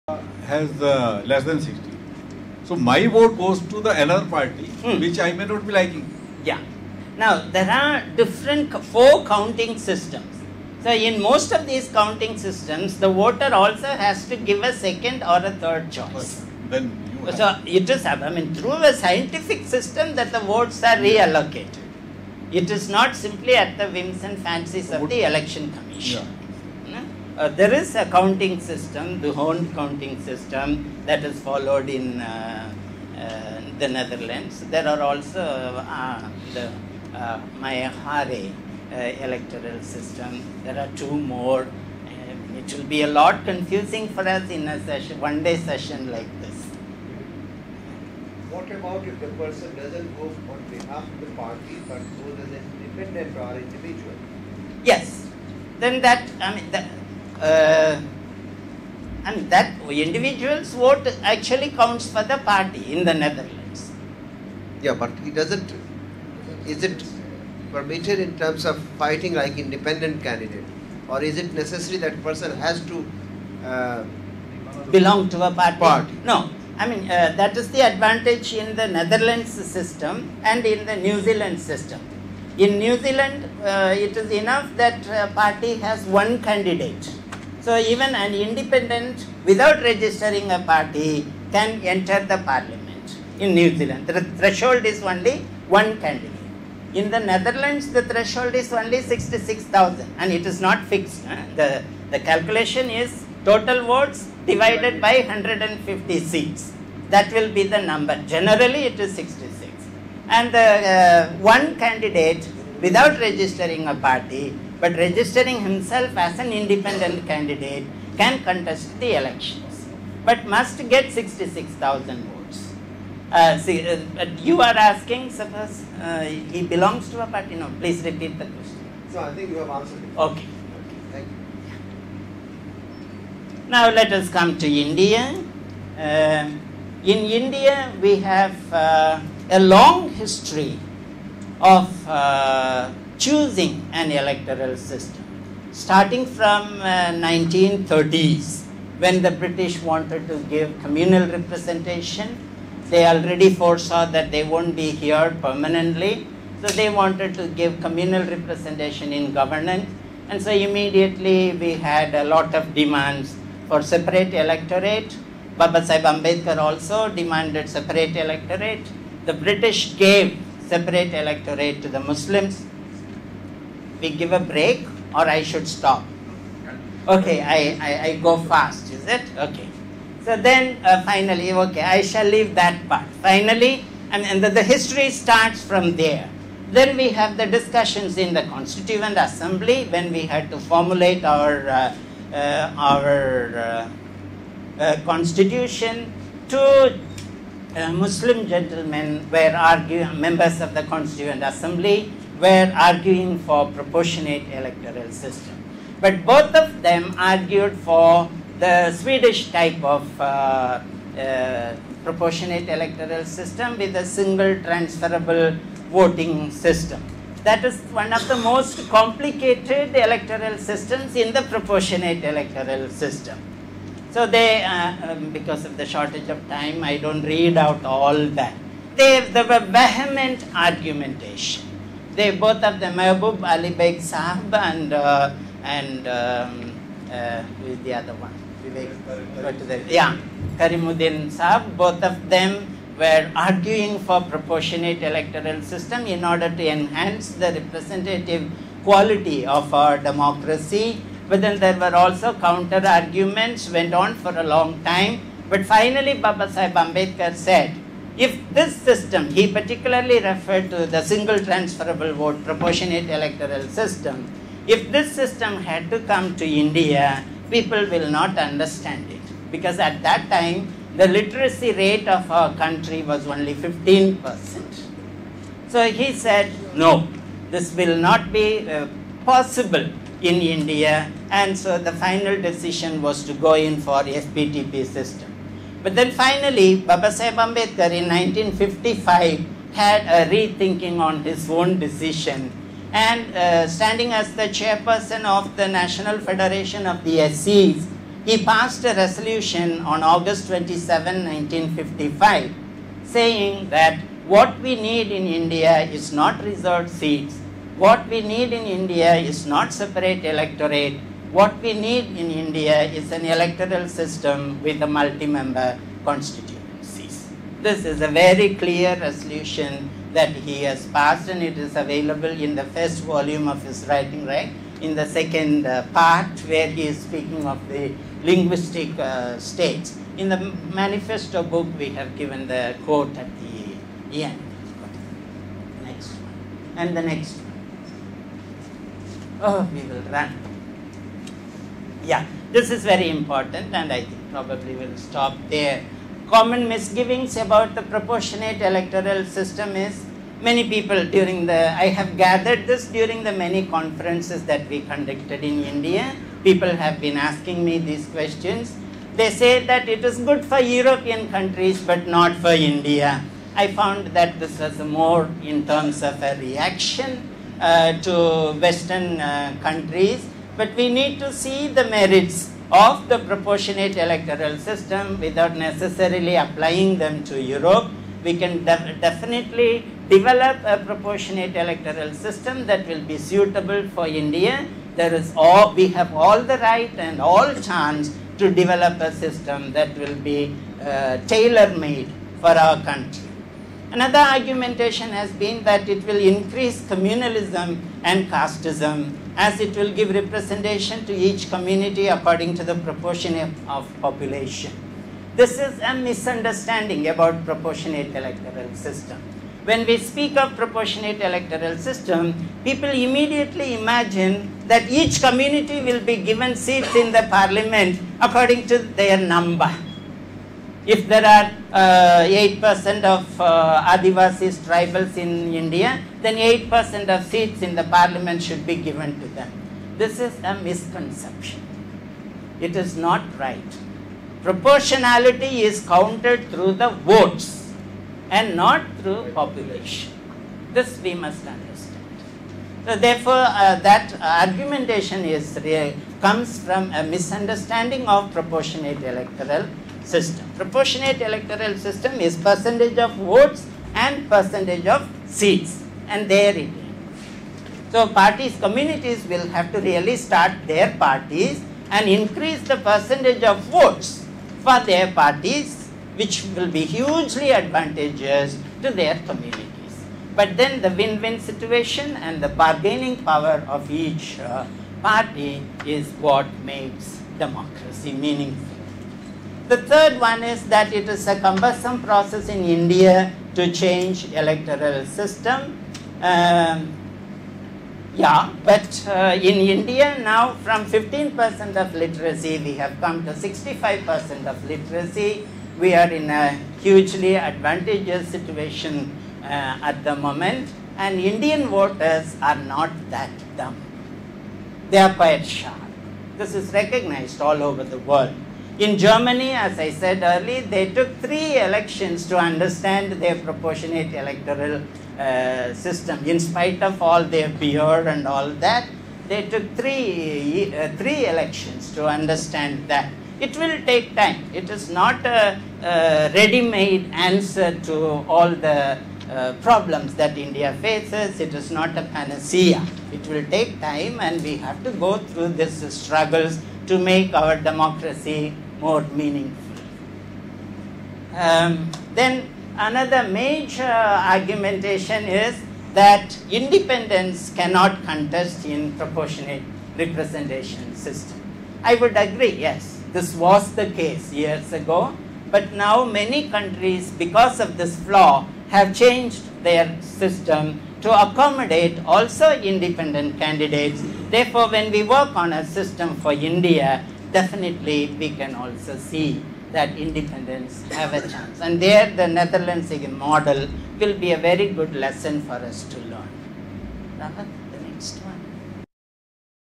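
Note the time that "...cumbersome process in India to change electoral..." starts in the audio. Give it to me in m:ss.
8:01.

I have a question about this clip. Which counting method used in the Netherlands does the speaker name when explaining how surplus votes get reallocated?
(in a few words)
Hoorn counting system.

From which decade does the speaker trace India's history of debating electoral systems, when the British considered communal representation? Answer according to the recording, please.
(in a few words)
1930s.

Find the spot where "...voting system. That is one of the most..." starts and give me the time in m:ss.
3:35.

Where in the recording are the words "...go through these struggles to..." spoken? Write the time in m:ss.
8:54.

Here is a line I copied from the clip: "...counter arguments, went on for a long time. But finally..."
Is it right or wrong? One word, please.
right.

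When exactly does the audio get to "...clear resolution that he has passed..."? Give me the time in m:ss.
5:18.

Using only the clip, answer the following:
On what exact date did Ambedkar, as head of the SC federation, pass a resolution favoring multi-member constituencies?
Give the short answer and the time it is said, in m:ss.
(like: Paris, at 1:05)
August 27, 1955, at 5:00.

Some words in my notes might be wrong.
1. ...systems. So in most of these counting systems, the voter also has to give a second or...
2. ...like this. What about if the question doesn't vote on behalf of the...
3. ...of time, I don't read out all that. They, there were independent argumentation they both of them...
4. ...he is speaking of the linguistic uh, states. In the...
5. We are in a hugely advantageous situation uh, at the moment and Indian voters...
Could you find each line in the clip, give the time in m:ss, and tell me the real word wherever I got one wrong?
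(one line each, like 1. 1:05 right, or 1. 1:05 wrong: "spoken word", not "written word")
1. 0:09 right
2. 0:46 wrong: "person", not "question"
3. 3:46 wrong: "vehement", not "independent"
4. 5:26 right
5. 8:15 right.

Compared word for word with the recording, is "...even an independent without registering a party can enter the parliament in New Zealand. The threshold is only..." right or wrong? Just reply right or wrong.
right.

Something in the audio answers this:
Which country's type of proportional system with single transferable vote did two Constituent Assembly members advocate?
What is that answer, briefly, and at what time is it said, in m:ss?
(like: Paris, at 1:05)
Swedish, at 3:28.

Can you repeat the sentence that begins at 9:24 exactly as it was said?
Therefore, when we work on a system for India, definitely we can also see that independents have a chance.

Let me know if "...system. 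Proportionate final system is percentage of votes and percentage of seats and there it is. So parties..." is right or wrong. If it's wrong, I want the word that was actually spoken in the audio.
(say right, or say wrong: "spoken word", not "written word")
wrong: "electoral", not "final".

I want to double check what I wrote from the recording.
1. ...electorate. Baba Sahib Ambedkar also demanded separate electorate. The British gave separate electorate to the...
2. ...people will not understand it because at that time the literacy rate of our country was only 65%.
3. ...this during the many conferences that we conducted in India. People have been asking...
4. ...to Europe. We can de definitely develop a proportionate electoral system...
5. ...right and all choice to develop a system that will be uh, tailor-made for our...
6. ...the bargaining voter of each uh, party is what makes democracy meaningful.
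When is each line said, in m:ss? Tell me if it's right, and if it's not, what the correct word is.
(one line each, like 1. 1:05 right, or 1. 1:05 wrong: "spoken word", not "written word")
1. 2:44 right
2. 4:27 wrong: "15", not "65"
3. 5:52 right
4. 6:17 right
5. 6:26 wrong: "chance", not "choice"
6. 7:52 wrong: "power", not "voter".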